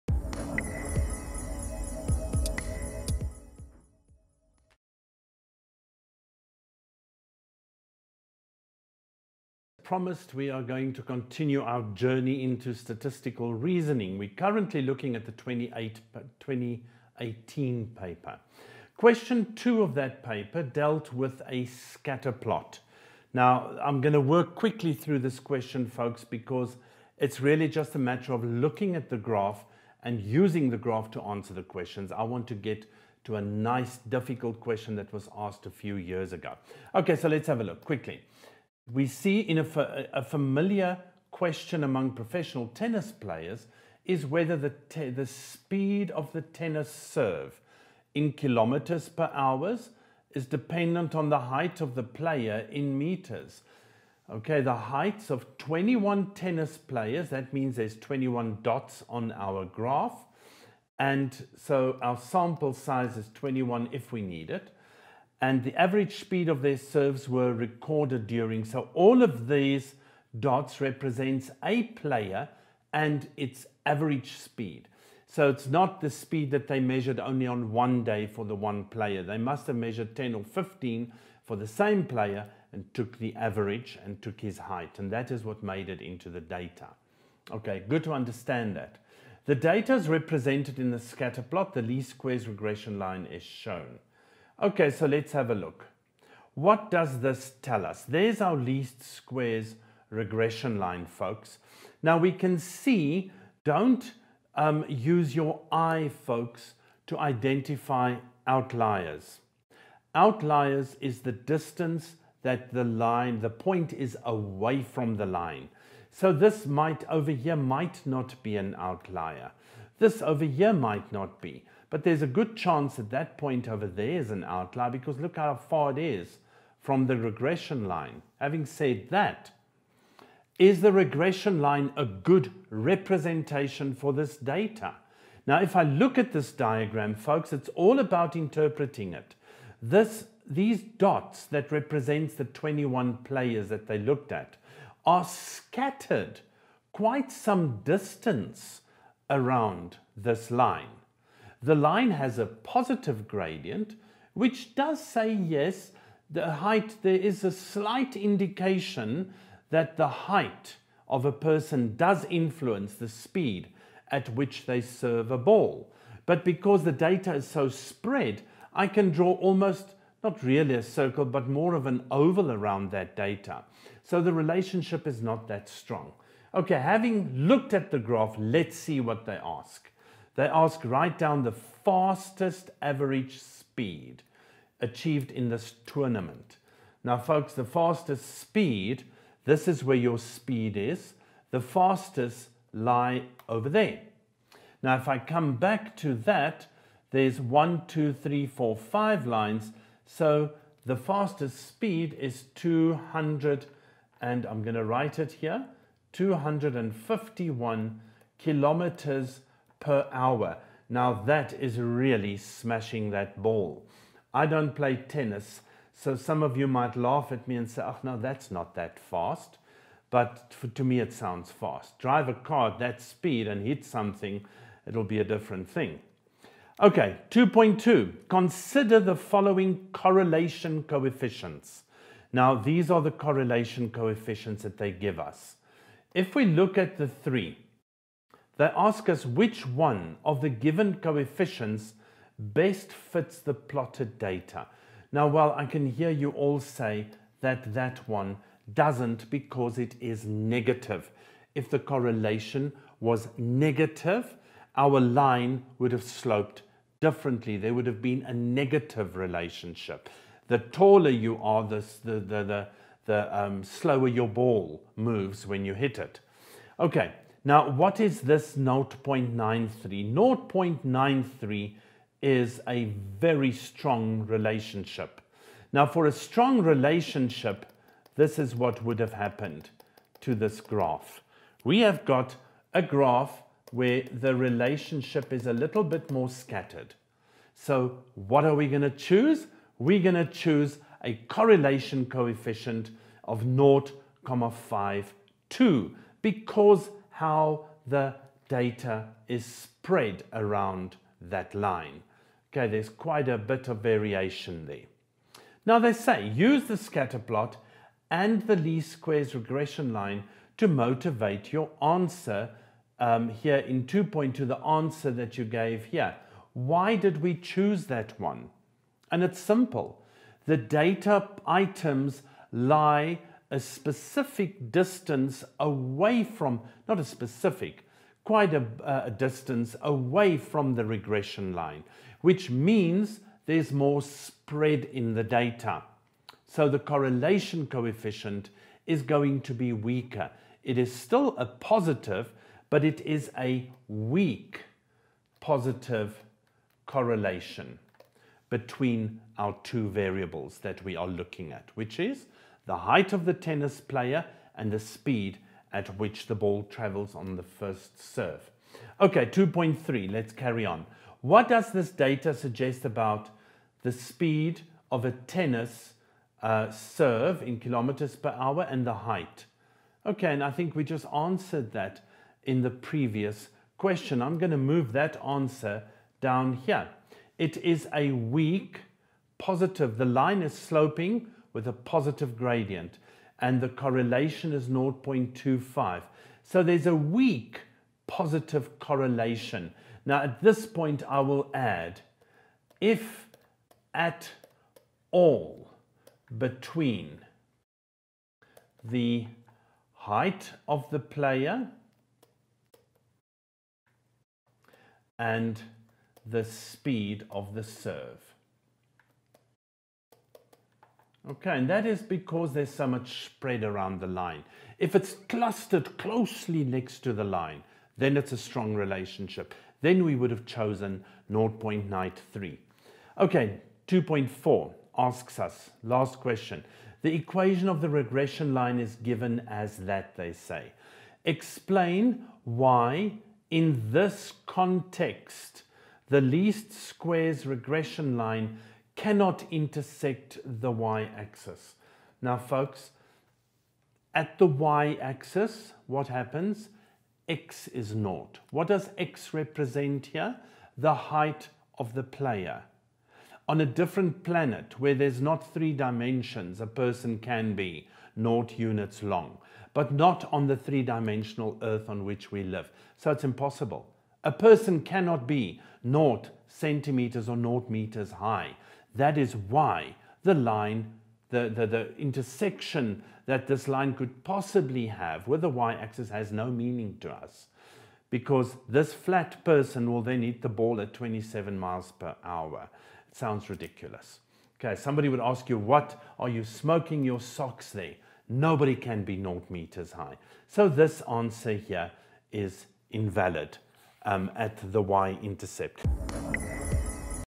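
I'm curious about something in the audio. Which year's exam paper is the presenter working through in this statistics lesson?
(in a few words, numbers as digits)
2018.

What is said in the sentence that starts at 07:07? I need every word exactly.
The equation of the regression line is given as that, they say.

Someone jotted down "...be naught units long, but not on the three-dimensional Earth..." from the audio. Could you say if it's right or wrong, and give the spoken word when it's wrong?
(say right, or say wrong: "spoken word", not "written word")
right.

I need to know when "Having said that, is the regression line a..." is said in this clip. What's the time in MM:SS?
02:08.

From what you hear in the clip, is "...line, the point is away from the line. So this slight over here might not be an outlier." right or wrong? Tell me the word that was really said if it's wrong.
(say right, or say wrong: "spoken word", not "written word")
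wrong: "might", not "slight".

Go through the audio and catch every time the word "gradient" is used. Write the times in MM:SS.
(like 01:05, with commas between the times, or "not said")
02:33, 06:22.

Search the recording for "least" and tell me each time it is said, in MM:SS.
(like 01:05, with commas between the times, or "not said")
01:31, 01:38, 05:08, 07:16.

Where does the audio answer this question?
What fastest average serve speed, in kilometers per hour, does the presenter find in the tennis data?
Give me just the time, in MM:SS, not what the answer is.
03:26.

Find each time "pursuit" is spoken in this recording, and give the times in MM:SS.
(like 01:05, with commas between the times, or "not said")
not said.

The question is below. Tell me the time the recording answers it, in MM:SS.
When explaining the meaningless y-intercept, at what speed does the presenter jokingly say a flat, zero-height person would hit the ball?
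08:00.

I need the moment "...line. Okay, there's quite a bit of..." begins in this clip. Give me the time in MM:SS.
05:01.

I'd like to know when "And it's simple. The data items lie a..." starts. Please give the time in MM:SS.
05:19.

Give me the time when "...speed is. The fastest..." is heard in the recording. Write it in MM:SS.
03:10.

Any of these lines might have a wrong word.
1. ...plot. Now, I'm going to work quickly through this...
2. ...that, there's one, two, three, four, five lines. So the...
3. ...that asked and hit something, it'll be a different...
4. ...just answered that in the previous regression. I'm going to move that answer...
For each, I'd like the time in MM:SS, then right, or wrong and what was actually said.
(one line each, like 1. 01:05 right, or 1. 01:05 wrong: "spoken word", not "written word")
1. 00:22 right
2. 03:16 right
3. 03:42 wrong: "speed", not "asked"
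4. 06:10 wrong: "question", not "regression".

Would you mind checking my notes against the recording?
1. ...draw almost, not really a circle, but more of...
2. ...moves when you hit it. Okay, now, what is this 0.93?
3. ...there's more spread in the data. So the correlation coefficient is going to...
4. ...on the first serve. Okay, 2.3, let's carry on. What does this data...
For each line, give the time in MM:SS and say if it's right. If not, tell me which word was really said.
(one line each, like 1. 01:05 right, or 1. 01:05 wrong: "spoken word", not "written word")
1. 02:49 right
2. 04:24 right
3. 05:33 right
4. 05:57 right.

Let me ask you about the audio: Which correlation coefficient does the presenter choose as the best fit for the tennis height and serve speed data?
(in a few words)
0.52.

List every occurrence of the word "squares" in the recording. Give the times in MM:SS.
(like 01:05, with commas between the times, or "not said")
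01:32, 01:39, 05:08, 07:16.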